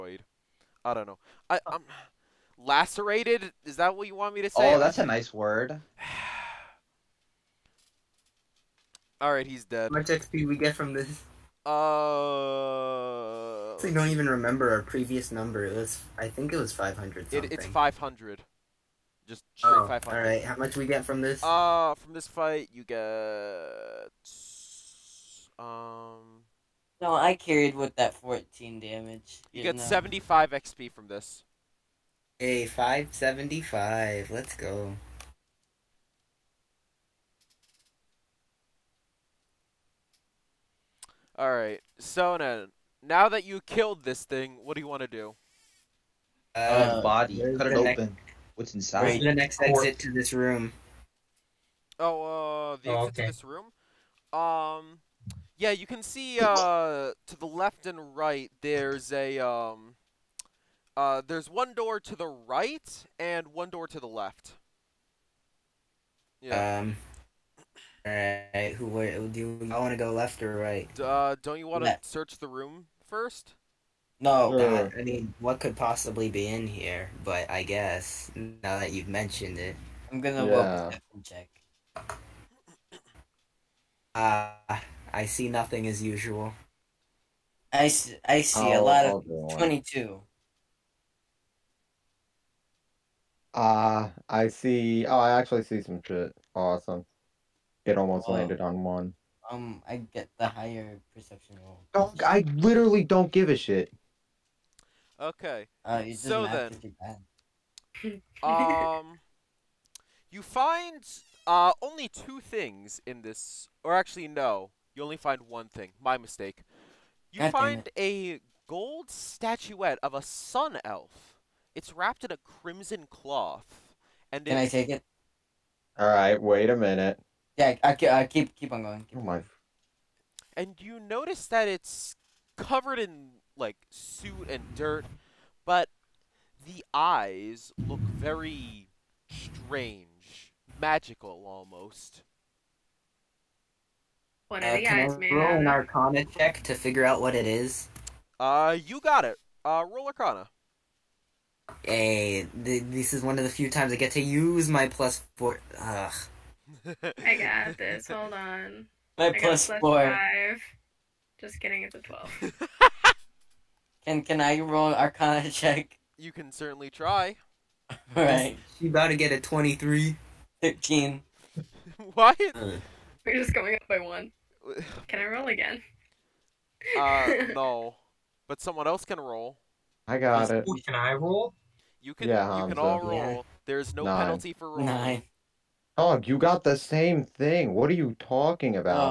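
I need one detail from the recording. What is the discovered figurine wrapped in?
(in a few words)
crimson cloth.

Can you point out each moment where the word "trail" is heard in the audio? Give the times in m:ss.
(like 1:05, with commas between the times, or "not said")
not said.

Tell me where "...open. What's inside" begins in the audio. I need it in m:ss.
0:47.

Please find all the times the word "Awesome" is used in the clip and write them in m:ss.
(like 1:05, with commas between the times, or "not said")
1:36.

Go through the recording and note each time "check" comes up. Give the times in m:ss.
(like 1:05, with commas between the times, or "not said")
1:21, 2:26, 2:45.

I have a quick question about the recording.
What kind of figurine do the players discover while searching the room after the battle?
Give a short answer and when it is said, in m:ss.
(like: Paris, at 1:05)
gold statuette of a sun elf, at 1:58.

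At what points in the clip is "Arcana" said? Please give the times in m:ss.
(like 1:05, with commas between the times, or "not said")
2:25, 2:30, 2:44.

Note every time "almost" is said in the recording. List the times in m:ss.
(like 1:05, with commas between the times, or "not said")
1:37, 2:21.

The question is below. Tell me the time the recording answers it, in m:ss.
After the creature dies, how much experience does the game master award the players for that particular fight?
0:29.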